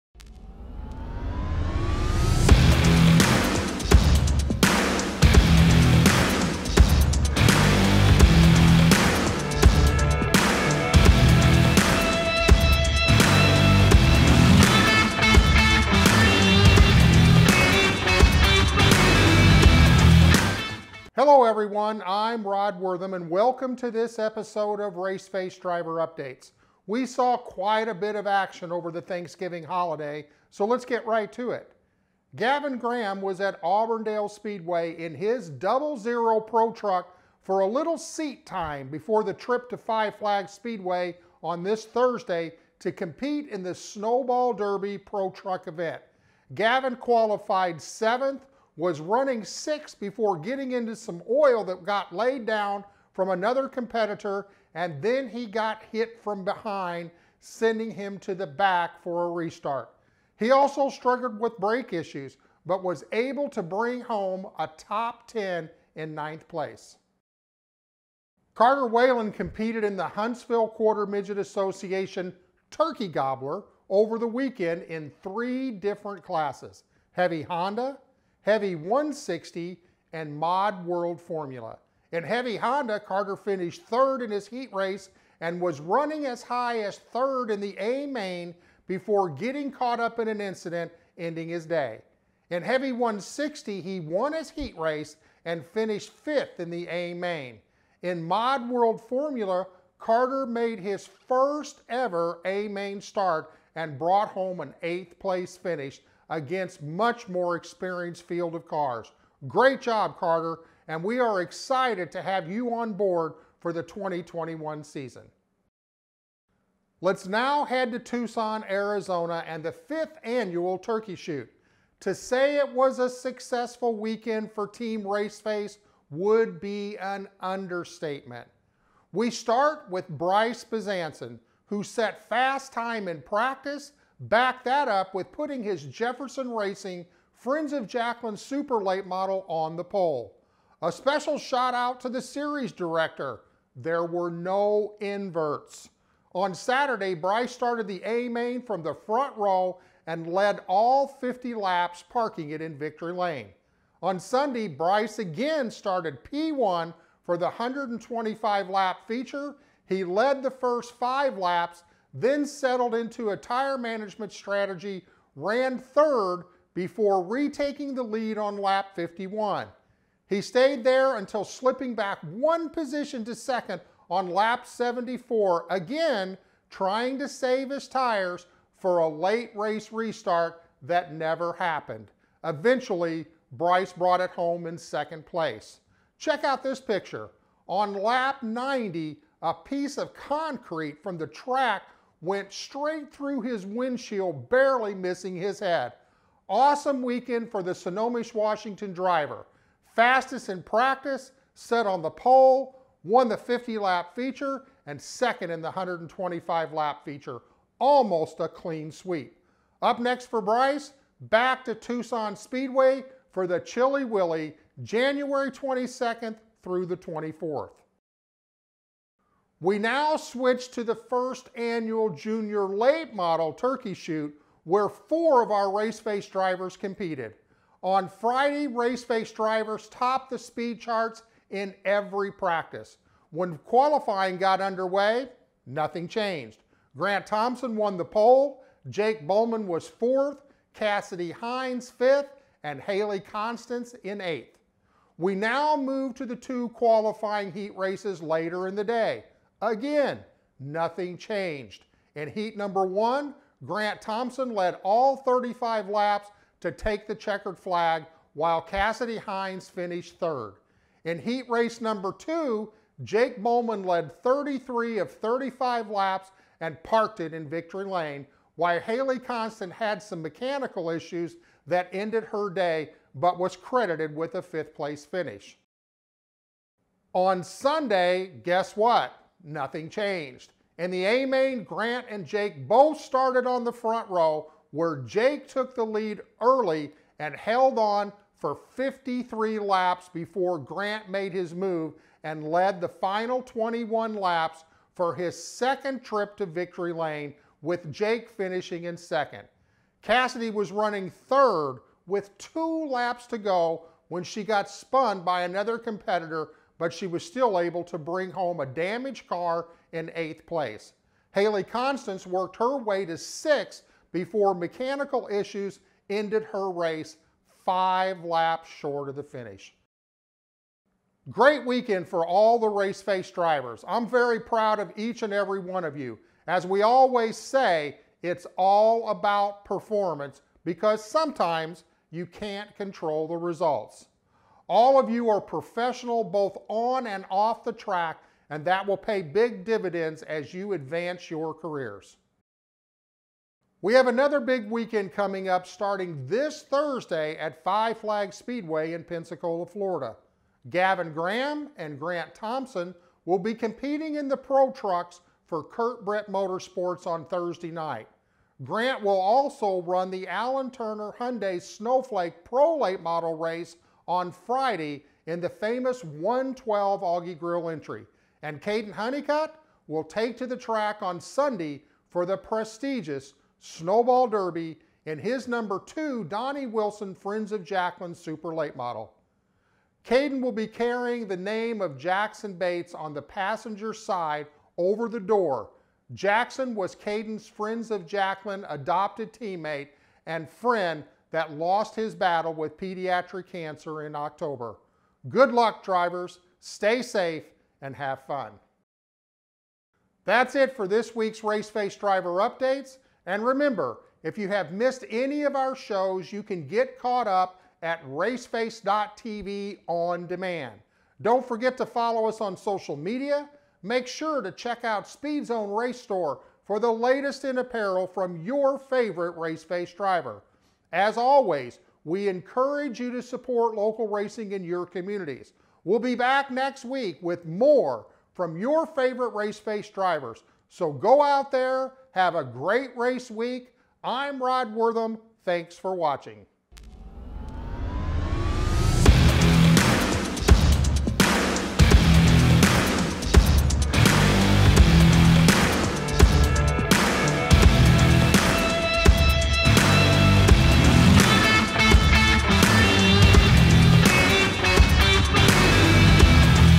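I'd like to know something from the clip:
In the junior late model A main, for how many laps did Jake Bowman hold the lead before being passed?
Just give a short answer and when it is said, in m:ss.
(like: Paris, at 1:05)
53, at 4:48.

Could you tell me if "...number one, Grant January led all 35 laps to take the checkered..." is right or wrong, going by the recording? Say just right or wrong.
wrong.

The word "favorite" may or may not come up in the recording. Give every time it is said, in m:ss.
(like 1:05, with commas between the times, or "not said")
6:58, 7:08.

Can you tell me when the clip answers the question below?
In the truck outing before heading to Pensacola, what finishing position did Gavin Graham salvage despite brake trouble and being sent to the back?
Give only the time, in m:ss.
1:06.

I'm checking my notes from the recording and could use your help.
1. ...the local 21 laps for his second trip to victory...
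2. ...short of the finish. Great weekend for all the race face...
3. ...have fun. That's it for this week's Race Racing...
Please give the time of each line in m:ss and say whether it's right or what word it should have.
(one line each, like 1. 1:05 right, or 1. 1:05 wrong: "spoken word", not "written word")
1. 4:52 wrong: "final", not "local"
2. 5:18 right
3. 6:37 wrong: "Face", not "Racing".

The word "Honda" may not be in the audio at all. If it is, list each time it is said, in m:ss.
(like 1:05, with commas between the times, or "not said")
1:17, 1:22.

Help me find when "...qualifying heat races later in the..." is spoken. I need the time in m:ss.
4:06.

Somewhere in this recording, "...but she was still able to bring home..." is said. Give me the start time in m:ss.
5:06.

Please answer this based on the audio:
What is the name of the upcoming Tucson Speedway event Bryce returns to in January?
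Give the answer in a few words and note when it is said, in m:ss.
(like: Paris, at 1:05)
Chilly Willy, at 3:33.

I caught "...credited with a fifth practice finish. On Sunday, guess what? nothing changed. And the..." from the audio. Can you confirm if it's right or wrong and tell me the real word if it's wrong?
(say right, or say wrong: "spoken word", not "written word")
wrong: "place", not "practice".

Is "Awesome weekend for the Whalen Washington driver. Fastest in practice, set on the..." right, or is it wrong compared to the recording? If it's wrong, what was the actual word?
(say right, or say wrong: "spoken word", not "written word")
wrong: "Snohomish", not "Whalen".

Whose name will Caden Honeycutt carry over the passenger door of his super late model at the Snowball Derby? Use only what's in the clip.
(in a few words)
Jackson Bates.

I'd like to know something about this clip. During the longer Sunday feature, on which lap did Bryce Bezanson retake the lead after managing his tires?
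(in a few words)
51.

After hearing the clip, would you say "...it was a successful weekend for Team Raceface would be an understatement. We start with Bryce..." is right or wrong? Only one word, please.
right.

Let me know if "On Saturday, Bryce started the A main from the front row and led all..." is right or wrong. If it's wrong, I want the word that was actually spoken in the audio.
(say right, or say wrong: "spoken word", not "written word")
right.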